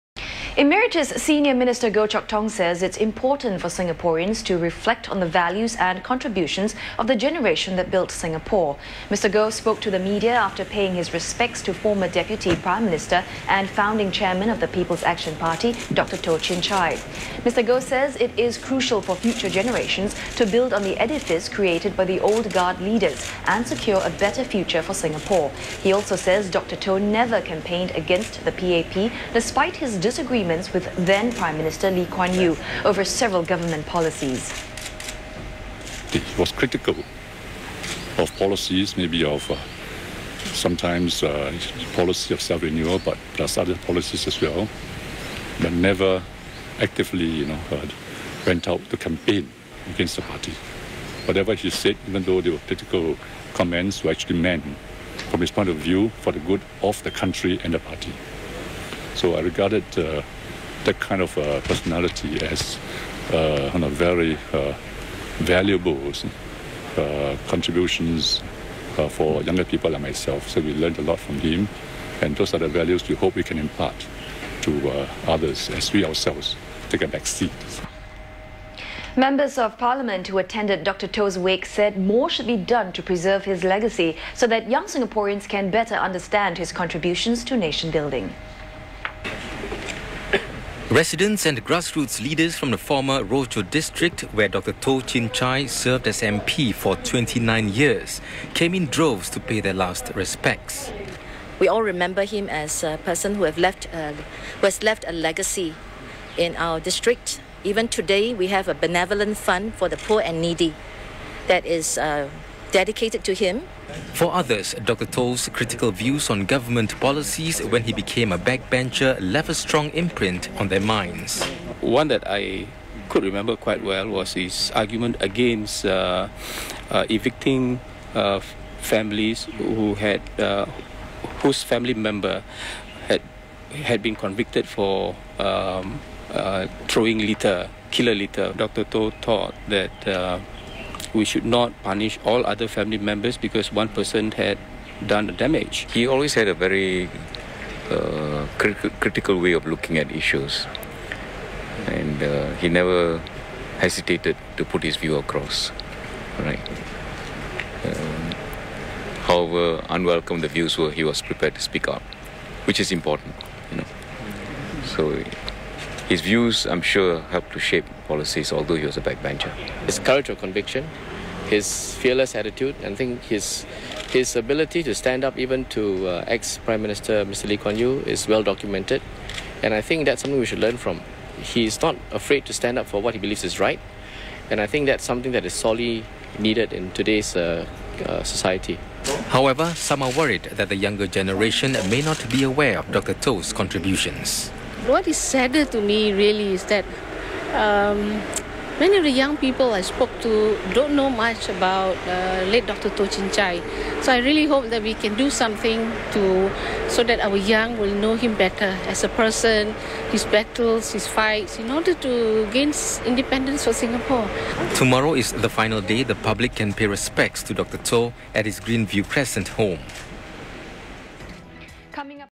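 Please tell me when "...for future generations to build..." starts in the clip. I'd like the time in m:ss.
0:19.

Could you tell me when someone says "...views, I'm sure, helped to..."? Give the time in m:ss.
2:46.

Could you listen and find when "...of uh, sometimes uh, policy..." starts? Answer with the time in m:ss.
0:39.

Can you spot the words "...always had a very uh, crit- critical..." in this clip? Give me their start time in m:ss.
2:26.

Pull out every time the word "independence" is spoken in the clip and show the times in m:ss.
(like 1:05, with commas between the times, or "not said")
3:33.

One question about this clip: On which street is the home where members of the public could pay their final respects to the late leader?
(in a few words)
Greenview Crescent.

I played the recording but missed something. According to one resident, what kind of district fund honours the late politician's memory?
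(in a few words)
benevolent fund.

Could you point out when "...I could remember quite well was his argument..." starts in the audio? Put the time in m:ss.
2:02.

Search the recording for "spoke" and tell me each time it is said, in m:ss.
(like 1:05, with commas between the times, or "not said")
0:09, 3:19.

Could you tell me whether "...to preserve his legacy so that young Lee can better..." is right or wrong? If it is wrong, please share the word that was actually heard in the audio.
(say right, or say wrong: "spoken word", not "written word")
wrong: "Singaporeans", not "Lee".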